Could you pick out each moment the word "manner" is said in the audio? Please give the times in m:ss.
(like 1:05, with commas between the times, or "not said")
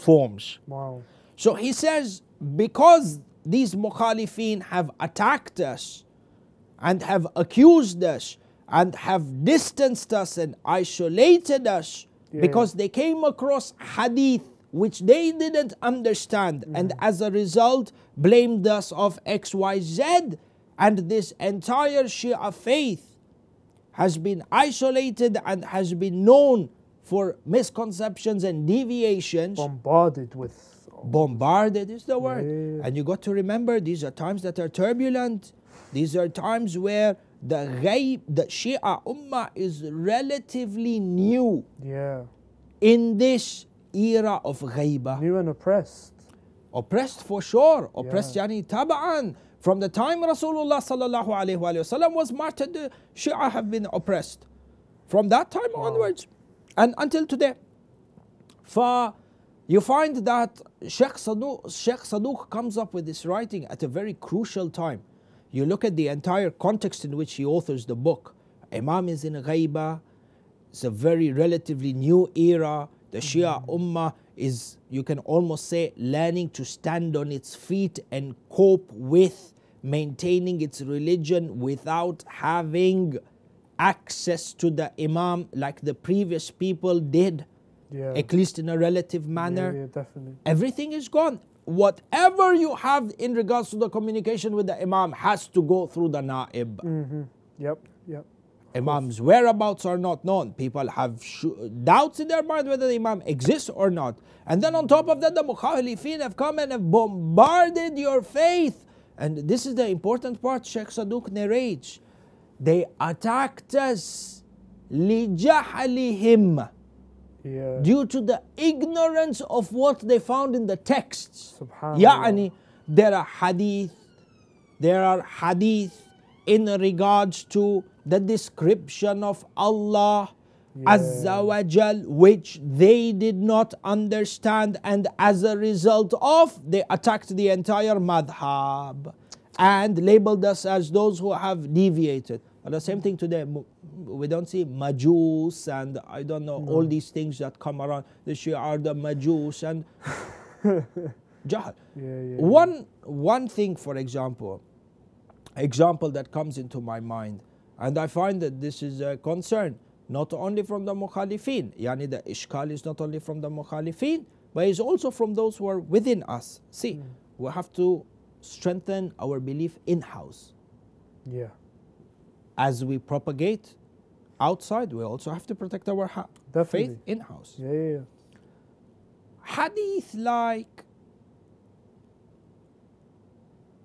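1:29.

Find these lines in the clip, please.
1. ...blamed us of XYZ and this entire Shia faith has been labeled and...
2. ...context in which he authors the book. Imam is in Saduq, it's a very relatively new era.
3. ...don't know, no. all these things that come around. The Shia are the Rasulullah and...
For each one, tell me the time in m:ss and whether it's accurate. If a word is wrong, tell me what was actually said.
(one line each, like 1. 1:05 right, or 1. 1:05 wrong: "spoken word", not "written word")
1. 0:18 wrong: "isolated", not "labeled"
2. 1:06 wrong: "Ghaiba", not "Saduq"
3. 2:26 wrong: "Majus", not "Rasulullah".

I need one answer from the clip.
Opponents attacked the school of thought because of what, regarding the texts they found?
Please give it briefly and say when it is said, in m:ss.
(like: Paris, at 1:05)
ignorance, at 1:58.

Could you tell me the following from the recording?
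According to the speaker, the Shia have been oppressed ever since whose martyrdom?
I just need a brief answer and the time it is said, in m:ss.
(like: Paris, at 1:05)
Rasulullah, at 0:50.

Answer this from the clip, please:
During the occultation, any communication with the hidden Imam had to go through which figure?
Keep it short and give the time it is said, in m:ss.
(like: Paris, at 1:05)
the naib, at 1:36.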